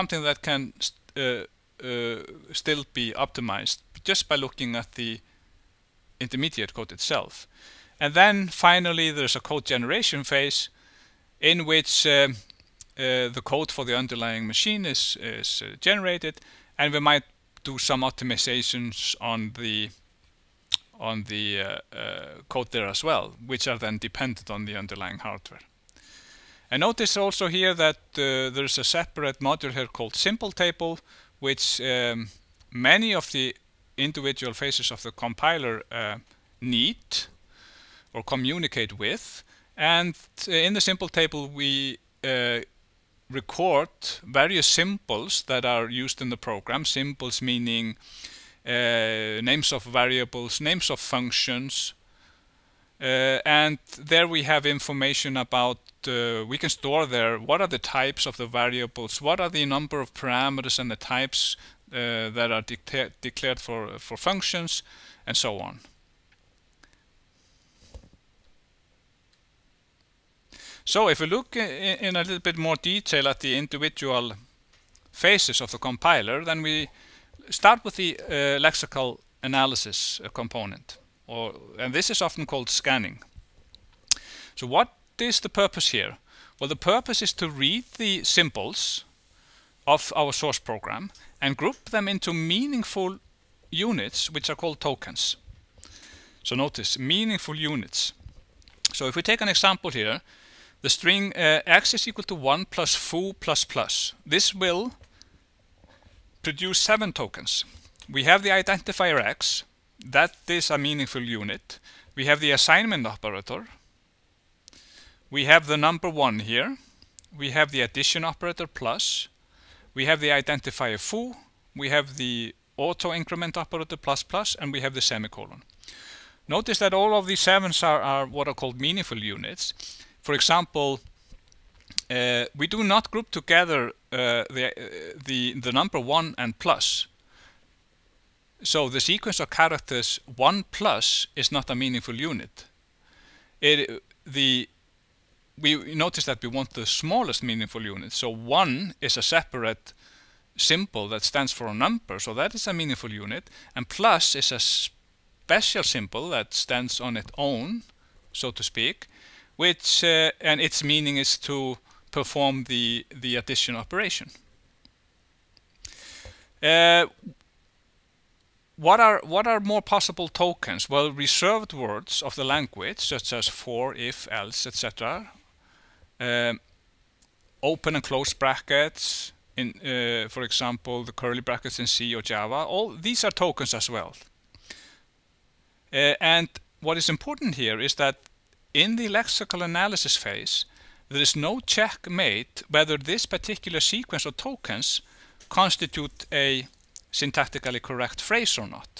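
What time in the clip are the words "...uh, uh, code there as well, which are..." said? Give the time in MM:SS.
00:21.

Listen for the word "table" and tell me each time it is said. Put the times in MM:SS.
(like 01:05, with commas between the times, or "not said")
00:30, 00:41.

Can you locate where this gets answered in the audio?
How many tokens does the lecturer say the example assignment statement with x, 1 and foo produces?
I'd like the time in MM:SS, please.
01:46.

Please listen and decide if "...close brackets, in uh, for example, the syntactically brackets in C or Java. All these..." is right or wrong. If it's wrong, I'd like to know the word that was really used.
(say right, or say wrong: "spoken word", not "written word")
wrong: "curly", not "syntactically".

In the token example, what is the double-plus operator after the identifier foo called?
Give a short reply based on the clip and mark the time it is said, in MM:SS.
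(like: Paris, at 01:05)
auto increment operator, at 02:02.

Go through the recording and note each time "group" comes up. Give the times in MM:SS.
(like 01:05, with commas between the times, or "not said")
01:31, 02:13.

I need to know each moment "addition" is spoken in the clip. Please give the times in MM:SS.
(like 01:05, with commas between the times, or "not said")
01:57, 02:43.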